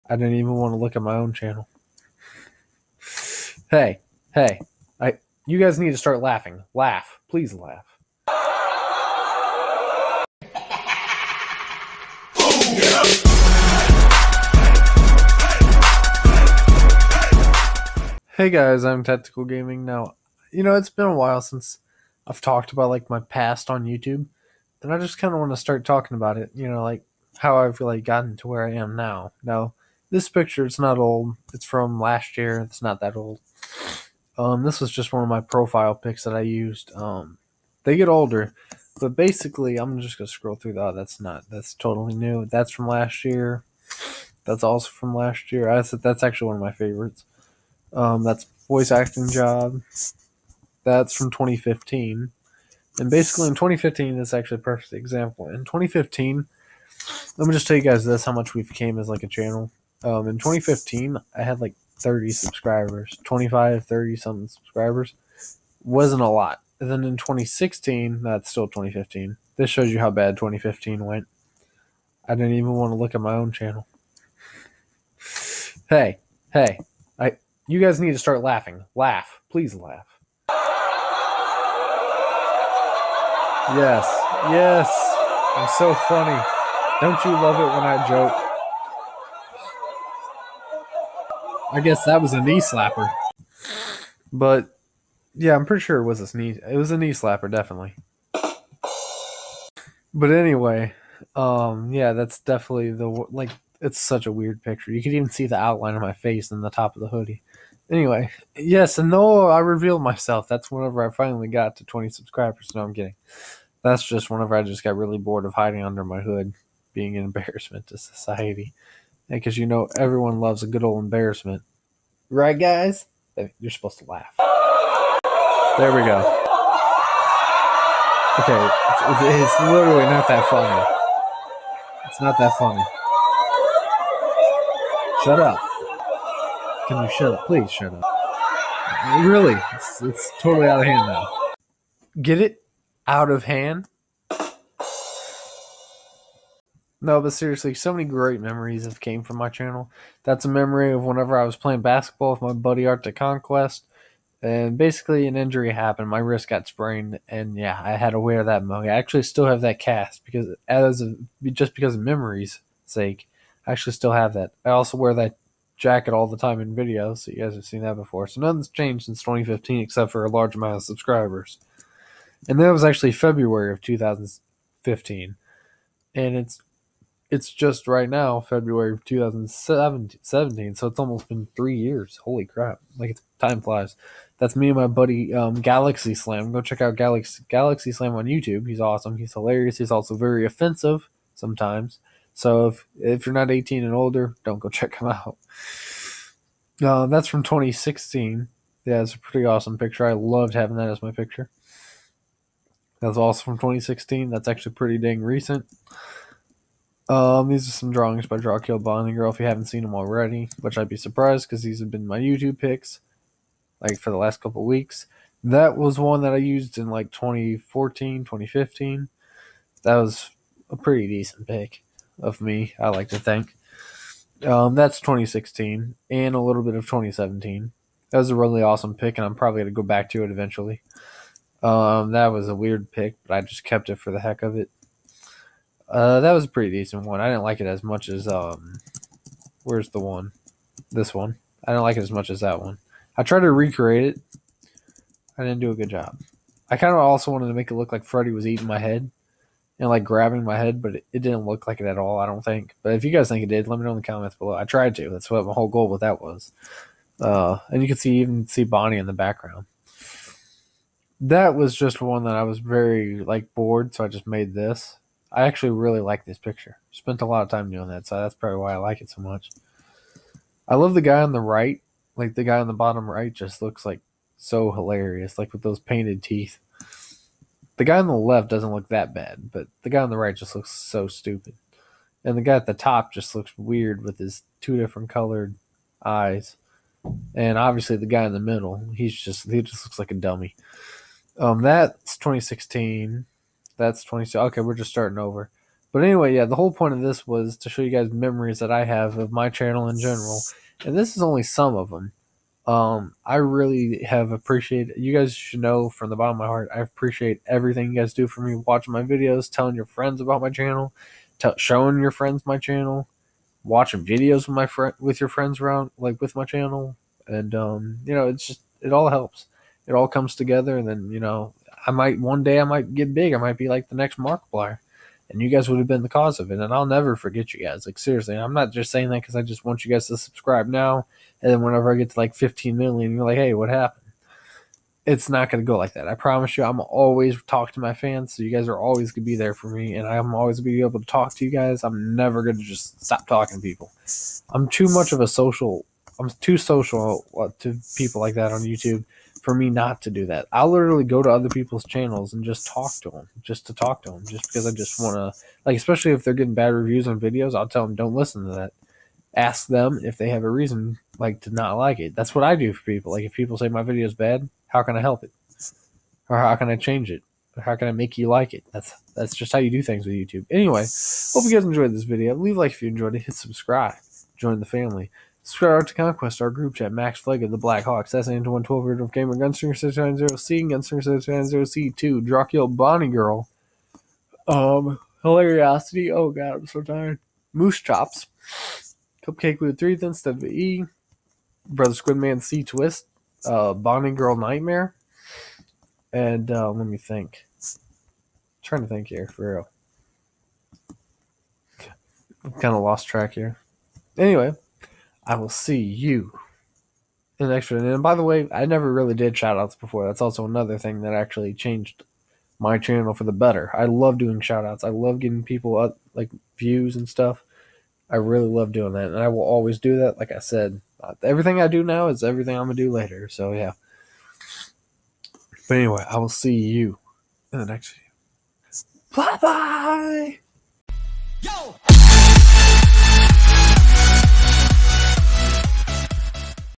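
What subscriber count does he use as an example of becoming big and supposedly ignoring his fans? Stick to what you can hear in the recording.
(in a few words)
15 million.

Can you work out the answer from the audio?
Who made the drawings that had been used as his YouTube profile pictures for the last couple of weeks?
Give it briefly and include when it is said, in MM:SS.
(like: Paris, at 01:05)
Drawkill Bonding Girl, at 03:28.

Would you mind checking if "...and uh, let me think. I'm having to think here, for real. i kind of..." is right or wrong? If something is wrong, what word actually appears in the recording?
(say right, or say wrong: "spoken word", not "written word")
wrong: "trying", not "having".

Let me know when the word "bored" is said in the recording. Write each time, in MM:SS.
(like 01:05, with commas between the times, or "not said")
01:55, 04:23.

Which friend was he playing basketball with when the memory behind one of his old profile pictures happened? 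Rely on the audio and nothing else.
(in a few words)
Art to Conquest.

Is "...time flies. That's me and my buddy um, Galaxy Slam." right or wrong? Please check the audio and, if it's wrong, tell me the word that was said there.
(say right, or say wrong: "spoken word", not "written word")
right.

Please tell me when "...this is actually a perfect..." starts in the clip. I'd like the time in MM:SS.
00:54.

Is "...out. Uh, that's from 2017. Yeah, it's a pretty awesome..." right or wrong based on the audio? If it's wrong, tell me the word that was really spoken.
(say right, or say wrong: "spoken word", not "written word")
wrong: "2016", not "2017".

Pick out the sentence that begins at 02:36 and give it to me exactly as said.
My wrist got sprained, and yeah, I had to wear that mug.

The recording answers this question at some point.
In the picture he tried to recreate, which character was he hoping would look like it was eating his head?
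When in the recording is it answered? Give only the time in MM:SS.
04:08.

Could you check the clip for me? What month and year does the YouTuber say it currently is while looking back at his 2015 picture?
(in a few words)
February 2017.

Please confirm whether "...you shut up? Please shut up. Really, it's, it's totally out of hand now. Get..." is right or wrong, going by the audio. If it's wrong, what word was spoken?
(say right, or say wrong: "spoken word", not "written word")
right.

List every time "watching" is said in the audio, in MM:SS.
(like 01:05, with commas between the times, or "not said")
05:08, 05:13.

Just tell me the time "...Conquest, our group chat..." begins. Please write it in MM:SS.
06:15.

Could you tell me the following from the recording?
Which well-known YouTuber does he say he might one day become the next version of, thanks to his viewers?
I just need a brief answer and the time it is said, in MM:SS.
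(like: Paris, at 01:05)
Markiplier, at 05:24.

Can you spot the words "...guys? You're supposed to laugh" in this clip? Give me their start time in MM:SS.
02:02.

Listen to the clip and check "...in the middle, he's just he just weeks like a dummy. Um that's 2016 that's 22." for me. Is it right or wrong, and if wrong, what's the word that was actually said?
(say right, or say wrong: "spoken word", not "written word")
wrong: "looks", not "weeks".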